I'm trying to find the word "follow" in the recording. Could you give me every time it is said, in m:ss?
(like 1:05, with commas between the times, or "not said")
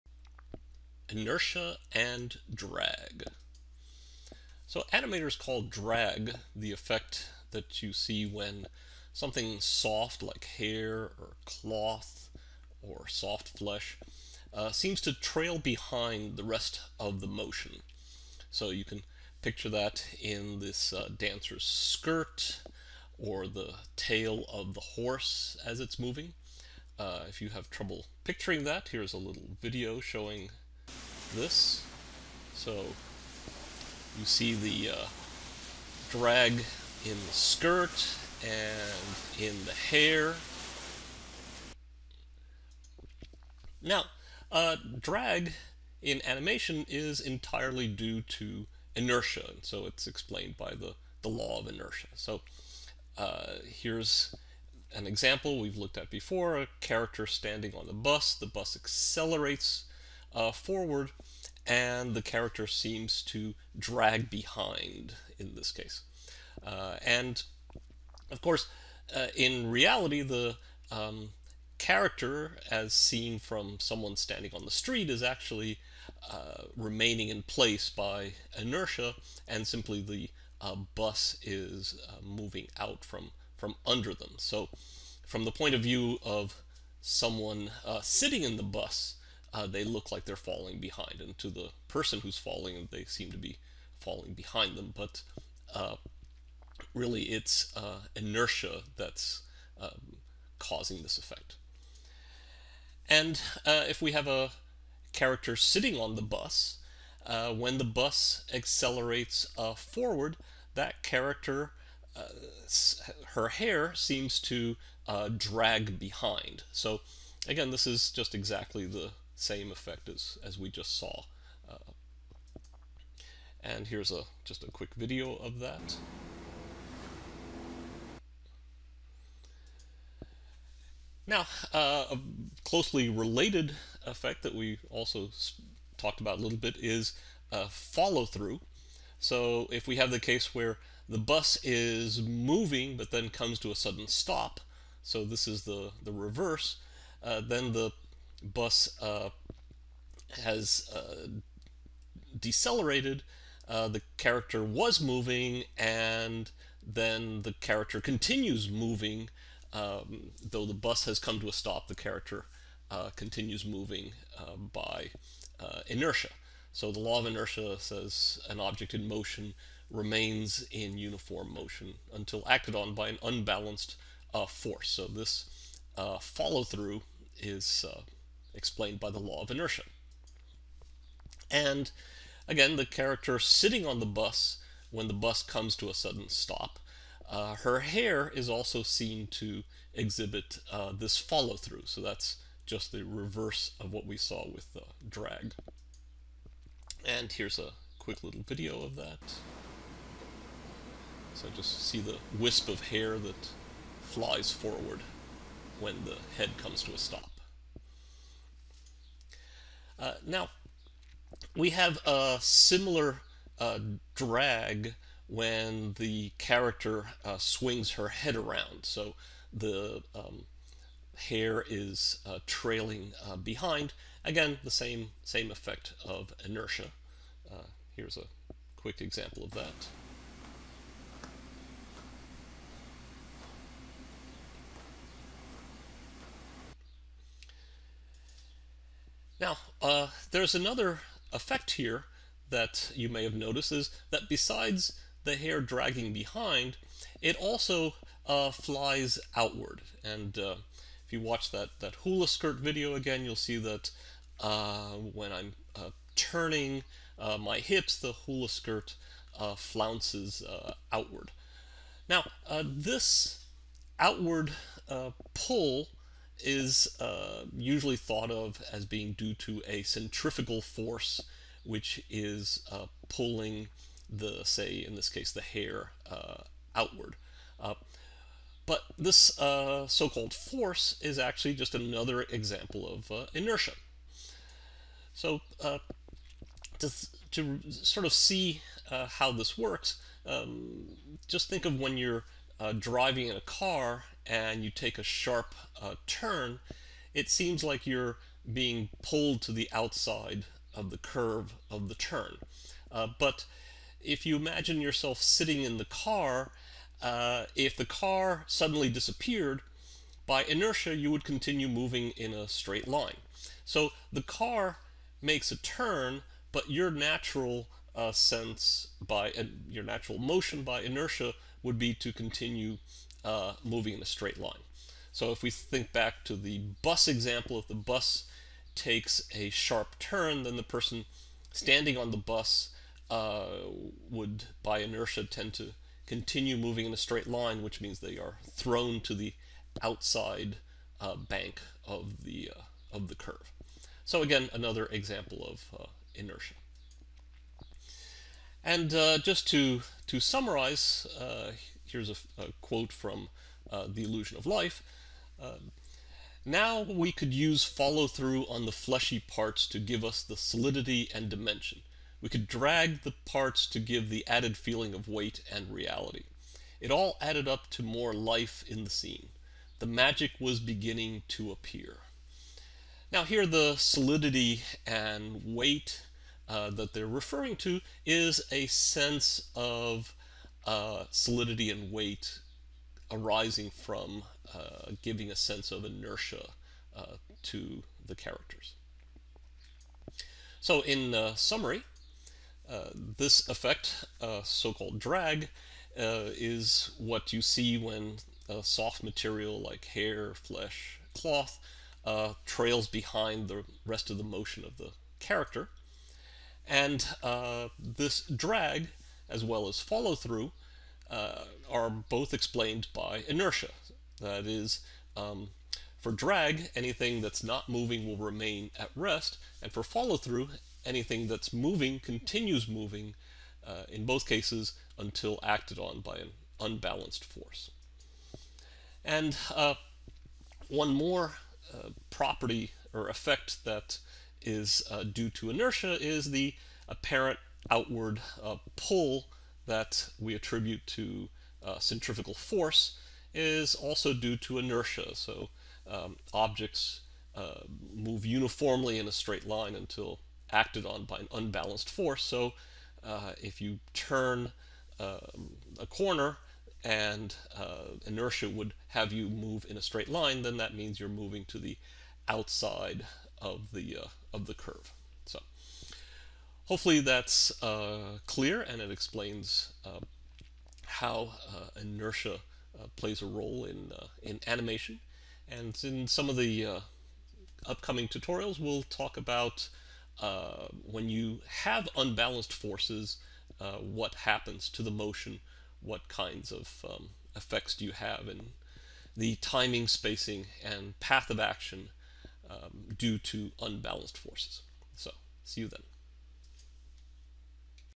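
2:17, 2:56, 3:11, 5:57, 6:49, 6:59.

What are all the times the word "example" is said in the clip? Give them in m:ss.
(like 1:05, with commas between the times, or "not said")
0:55, 3:49, 4:42, 5:27, 5:44.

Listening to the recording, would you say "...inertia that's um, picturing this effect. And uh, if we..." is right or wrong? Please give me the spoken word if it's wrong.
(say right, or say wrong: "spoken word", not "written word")
wrong: "causing", not "picturing".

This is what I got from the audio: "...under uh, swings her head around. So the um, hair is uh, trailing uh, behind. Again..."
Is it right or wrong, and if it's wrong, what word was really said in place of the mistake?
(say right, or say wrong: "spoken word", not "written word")
wrong: "character", not "under".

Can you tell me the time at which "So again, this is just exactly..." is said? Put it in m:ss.
1:56.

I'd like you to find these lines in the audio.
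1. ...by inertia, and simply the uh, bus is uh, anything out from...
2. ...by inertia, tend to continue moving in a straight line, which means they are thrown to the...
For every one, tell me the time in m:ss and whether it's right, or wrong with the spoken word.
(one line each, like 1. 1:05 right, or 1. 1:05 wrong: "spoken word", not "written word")
1. 1:17 wrong: "moving", not "anything"
2. 5:34 right.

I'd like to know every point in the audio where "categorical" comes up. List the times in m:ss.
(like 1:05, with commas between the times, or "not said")
not said.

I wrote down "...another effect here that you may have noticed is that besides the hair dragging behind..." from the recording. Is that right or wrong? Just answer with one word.
right.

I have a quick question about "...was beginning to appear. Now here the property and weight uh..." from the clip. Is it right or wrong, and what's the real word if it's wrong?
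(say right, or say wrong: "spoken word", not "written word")
wrong: "solidity", not "property".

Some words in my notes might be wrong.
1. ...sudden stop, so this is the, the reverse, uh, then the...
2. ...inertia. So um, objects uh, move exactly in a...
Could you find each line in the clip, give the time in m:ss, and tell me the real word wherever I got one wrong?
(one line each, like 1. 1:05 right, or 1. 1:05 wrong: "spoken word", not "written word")
1. 2:23 right
2. 7:24 wrong: "uniformly", not "exactly".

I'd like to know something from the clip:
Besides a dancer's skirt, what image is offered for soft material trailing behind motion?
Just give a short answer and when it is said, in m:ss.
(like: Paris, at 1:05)
the tail of the horse, at 0:23.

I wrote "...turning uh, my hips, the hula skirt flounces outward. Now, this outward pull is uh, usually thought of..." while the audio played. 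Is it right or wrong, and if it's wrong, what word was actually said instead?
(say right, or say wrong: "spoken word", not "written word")
right.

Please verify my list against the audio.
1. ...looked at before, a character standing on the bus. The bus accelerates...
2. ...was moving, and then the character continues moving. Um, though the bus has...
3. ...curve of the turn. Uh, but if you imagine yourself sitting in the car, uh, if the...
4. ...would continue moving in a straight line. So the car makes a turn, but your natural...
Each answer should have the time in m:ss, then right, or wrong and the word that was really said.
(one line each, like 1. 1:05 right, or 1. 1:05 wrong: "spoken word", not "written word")
1. 0:55 right
2. 2:34 right
3. 5:00 right
4. 5:11 right.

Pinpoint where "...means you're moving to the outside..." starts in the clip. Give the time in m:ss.
7:40.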